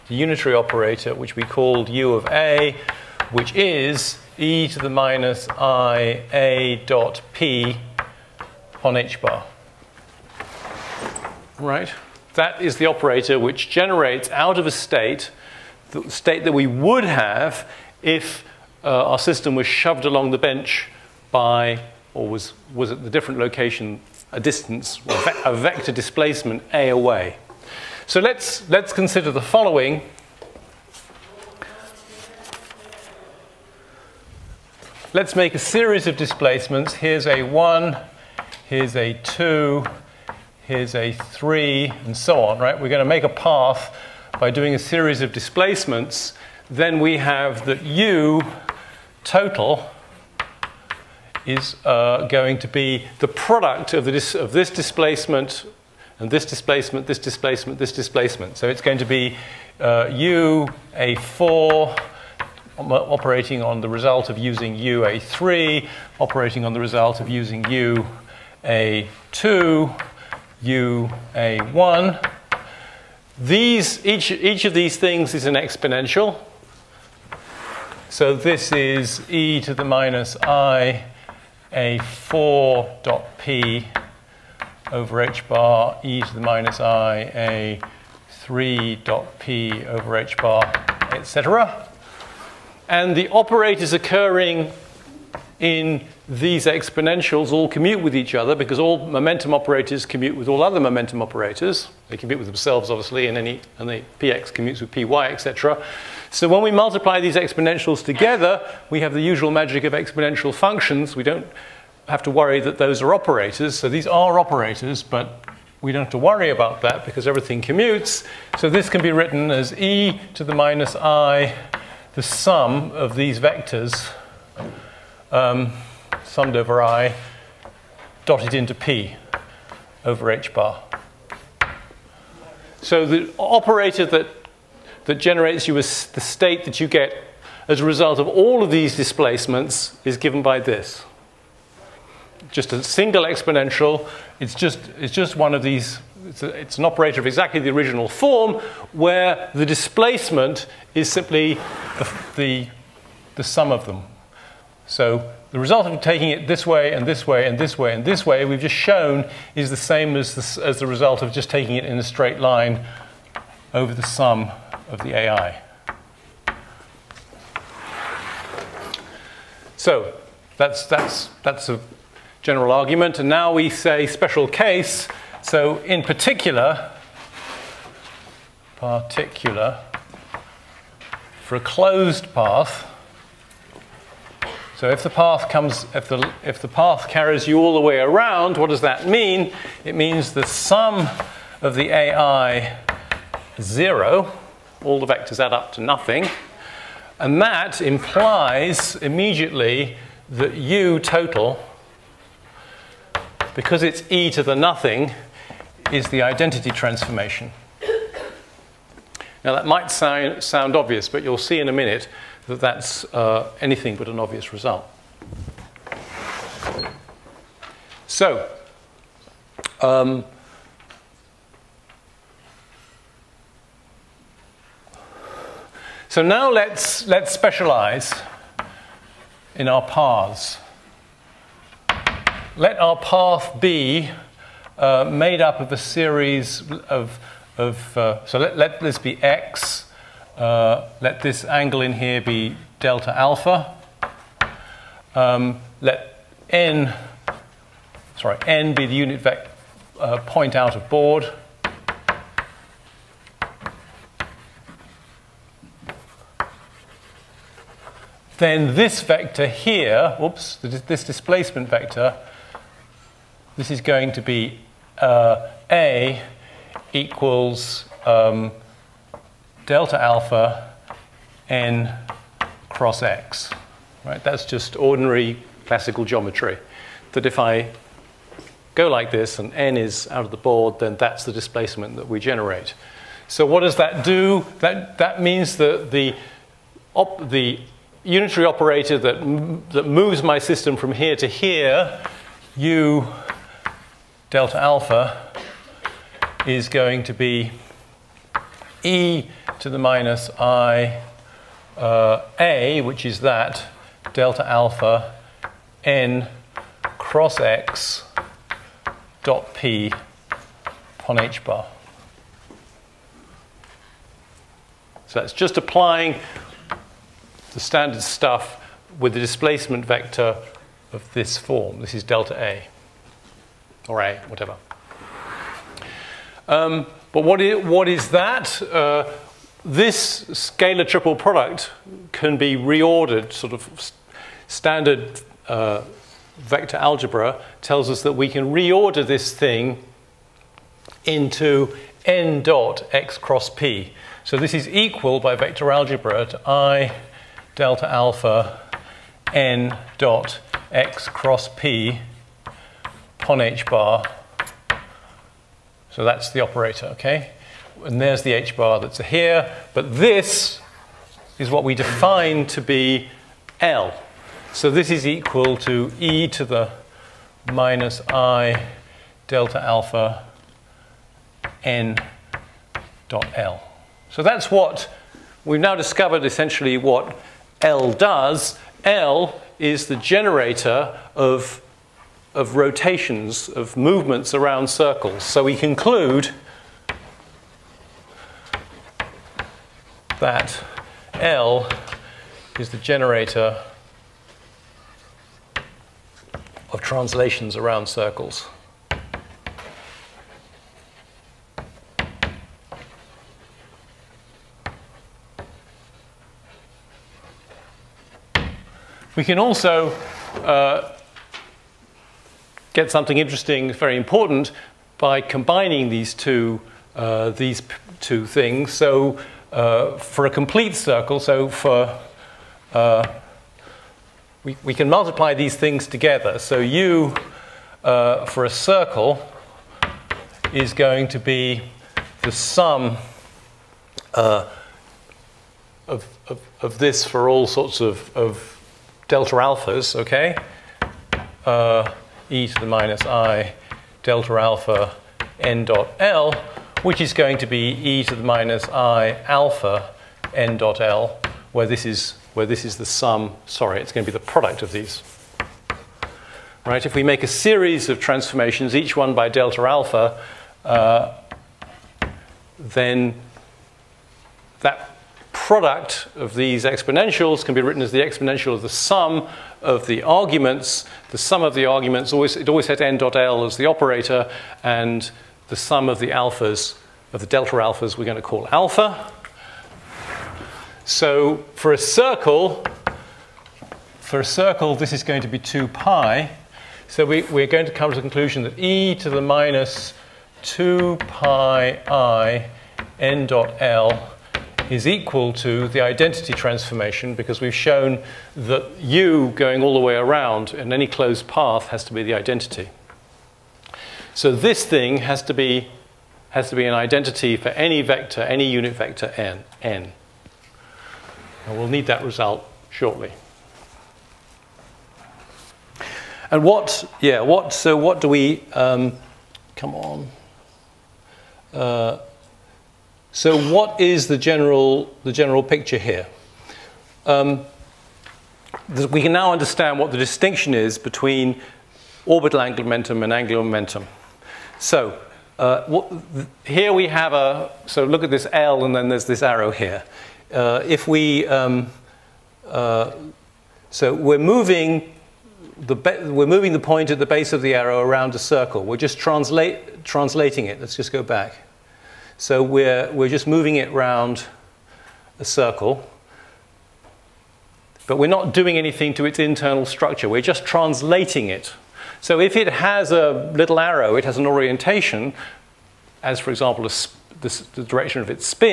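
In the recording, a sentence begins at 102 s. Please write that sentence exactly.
They commute with themselves, obviously, and, any, and the px commutes with py, etc.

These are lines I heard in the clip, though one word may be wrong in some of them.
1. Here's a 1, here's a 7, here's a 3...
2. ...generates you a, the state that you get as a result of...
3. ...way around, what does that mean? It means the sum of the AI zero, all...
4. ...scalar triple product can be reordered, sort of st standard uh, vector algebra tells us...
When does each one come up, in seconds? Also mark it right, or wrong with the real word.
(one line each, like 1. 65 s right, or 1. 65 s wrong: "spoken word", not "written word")
1. 36 s wrong: "2", not "7"
2. 135 s right
3. 187 s right
4. 330 s right.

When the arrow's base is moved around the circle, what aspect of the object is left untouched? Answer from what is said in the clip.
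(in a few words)
Internal structure.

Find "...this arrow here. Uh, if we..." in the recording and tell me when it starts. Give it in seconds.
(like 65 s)
539 s.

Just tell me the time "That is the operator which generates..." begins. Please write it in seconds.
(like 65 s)
12 s.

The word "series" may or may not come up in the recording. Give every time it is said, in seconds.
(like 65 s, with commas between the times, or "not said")
35 s, 44 s, 235 s, 457 s.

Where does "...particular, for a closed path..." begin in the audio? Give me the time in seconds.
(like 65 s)
178 s.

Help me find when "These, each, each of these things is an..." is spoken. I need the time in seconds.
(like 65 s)
73 s.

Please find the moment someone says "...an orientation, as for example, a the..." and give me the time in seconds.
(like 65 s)
564 s.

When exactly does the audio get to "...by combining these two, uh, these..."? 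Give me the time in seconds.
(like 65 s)
414 s.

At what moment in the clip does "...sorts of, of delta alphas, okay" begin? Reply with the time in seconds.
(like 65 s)
437 s.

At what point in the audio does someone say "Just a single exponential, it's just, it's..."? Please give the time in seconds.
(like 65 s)
142 s.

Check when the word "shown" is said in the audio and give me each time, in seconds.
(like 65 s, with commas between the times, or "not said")
158 s, 497 s.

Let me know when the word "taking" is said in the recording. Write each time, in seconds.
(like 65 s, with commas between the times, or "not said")
156 s, 161 s.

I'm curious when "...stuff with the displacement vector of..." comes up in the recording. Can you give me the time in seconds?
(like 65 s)
318 s.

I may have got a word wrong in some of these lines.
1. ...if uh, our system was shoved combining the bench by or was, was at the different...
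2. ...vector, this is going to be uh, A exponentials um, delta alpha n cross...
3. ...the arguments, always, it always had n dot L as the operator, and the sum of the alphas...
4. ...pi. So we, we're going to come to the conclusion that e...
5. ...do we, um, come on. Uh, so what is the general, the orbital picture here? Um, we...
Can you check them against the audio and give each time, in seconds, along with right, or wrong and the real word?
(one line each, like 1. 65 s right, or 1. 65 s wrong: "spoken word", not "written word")
1. 18 s wrong: "along", not "combining"
2. 261 s wrong: "equals", not "exponentials"
3. 471 s right
4. 485 s right
5. 518 s wrong: "general", not "orbital".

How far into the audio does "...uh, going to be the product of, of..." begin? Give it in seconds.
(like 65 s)
51 s.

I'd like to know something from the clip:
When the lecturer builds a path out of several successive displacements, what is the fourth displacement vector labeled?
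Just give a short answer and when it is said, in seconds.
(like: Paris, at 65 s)
a4, at 60 s.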